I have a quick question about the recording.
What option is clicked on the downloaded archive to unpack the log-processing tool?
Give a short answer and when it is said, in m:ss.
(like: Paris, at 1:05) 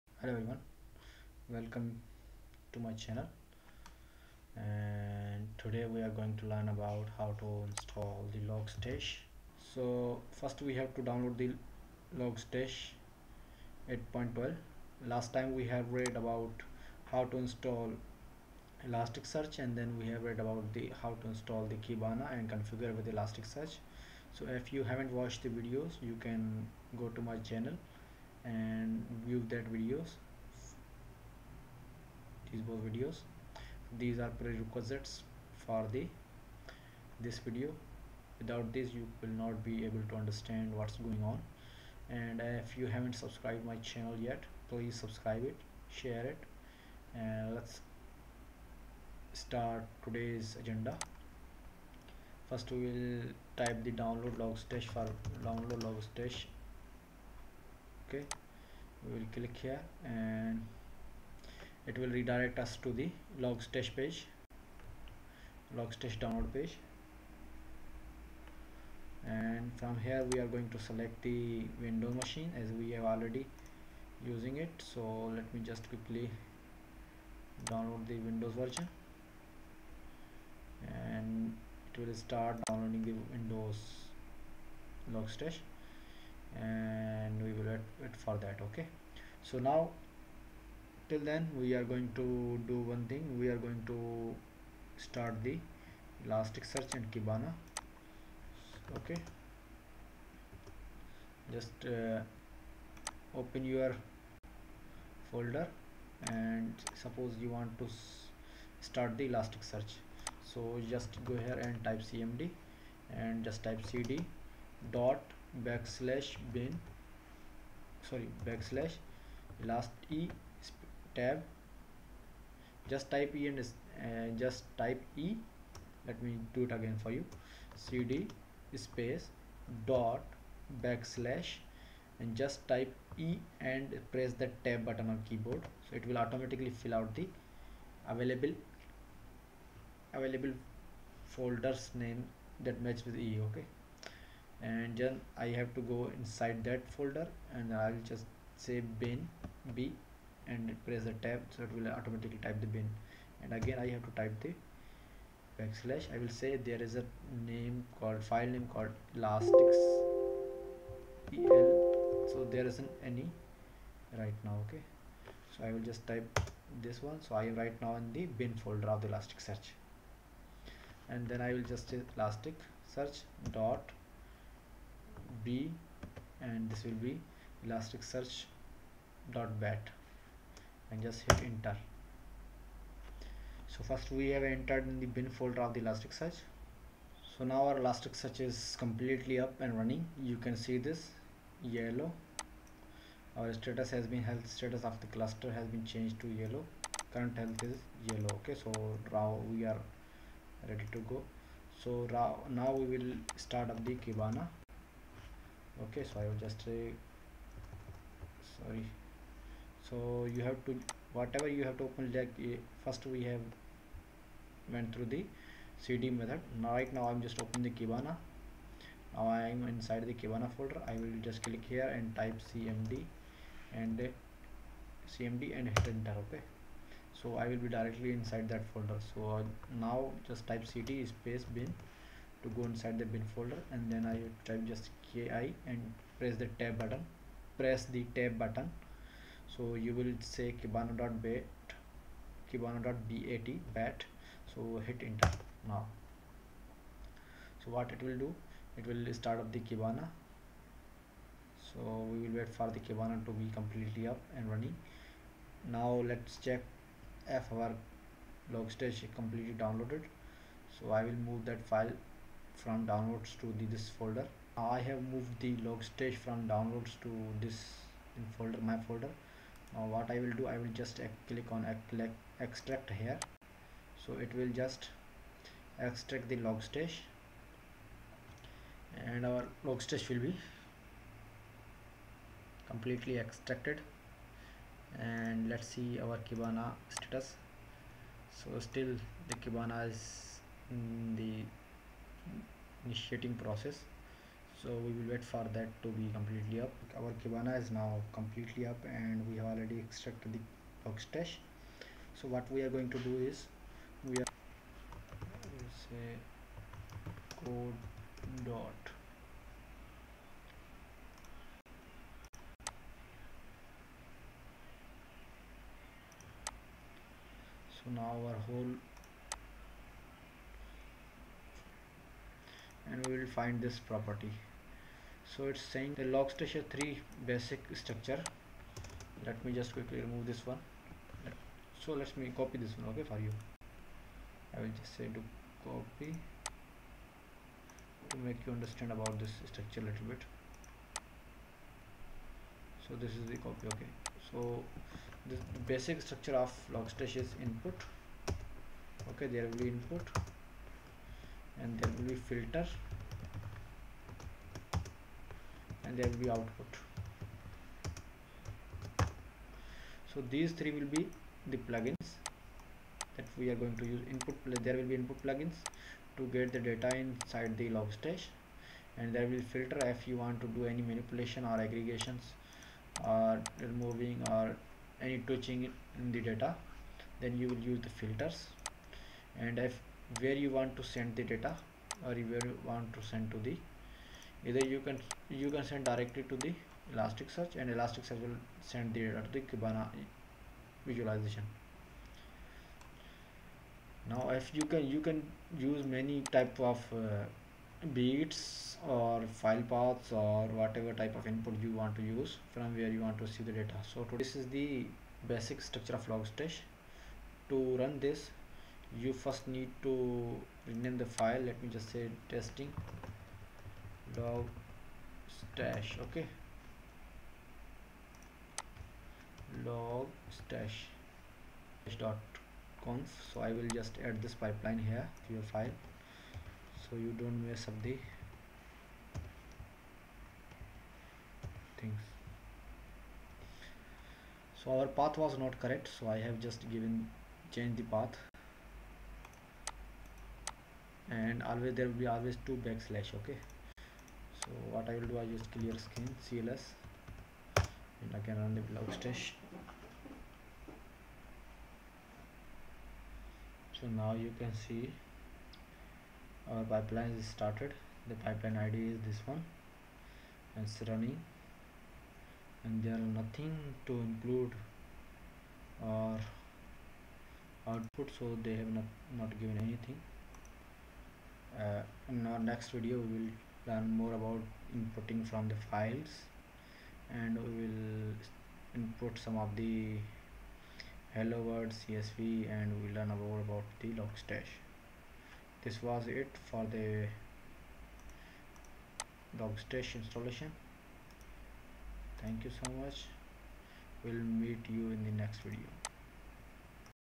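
Extract here, at 4:32.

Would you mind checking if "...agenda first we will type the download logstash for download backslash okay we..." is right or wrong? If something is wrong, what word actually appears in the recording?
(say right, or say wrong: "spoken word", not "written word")
wrong: "logstash", not "backslash".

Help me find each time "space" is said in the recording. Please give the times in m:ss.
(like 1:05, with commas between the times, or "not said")
2:08, 3:51.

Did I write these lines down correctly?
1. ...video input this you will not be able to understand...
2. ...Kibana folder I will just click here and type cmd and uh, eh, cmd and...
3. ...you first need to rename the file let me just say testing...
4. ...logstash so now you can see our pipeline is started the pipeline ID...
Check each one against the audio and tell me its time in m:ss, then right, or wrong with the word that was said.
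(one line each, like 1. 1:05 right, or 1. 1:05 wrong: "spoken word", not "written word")
1. 0:37 wrong: "without", not "input"
2. 3:40 right
3. 6:48 right
4. 7:28 right.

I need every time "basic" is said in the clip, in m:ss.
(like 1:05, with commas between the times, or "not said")
5:27, 5:45, 6:45.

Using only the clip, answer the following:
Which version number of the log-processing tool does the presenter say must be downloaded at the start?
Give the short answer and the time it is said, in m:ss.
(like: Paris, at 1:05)
8.12, at 0:13.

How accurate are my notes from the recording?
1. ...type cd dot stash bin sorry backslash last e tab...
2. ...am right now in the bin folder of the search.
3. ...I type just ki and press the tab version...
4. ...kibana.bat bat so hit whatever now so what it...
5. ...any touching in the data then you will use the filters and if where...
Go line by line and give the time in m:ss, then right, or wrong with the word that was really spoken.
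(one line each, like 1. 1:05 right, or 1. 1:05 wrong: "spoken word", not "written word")
1. 1:53 wrong: "backslash", not "stash"
2. 2:47 right
3. 3:54 wrong: "button", not "version"
4. 4:02 wrong: "enter", not "whatever"
5. 6:15 right.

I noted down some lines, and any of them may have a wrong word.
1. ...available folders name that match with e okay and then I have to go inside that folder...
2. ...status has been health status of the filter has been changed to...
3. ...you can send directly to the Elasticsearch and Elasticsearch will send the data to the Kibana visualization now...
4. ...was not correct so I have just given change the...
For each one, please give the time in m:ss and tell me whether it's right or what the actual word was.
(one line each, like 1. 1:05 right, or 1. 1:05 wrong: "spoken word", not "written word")
1. 2:20 right
2. 3:13 wrong: "cluster", not "filter"
3. 6:25 right
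4. 7:15 right.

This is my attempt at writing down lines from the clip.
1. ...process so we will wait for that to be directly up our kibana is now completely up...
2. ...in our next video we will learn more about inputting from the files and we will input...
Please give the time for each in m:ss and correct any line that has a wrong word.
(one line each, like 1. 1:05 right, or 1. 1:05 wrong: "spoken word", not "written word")
1. 4:53 wrong: "completely", not "directly"
2. 7:52 right.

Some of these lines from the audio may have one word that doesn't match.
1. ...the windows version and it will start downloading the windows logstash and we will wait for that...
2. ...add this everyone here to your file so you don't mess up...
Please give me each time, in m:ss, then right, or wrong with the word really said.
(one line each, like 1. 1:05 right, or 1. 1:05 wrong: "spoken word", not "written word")
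1. 1:18 right
2. 7:04 wrong: "pipeline", not "everyone".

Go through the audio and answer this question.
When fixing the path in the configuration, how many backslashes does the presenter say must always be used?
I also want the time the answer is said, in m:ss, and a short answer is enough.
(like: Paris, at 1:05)
2, at 7:22.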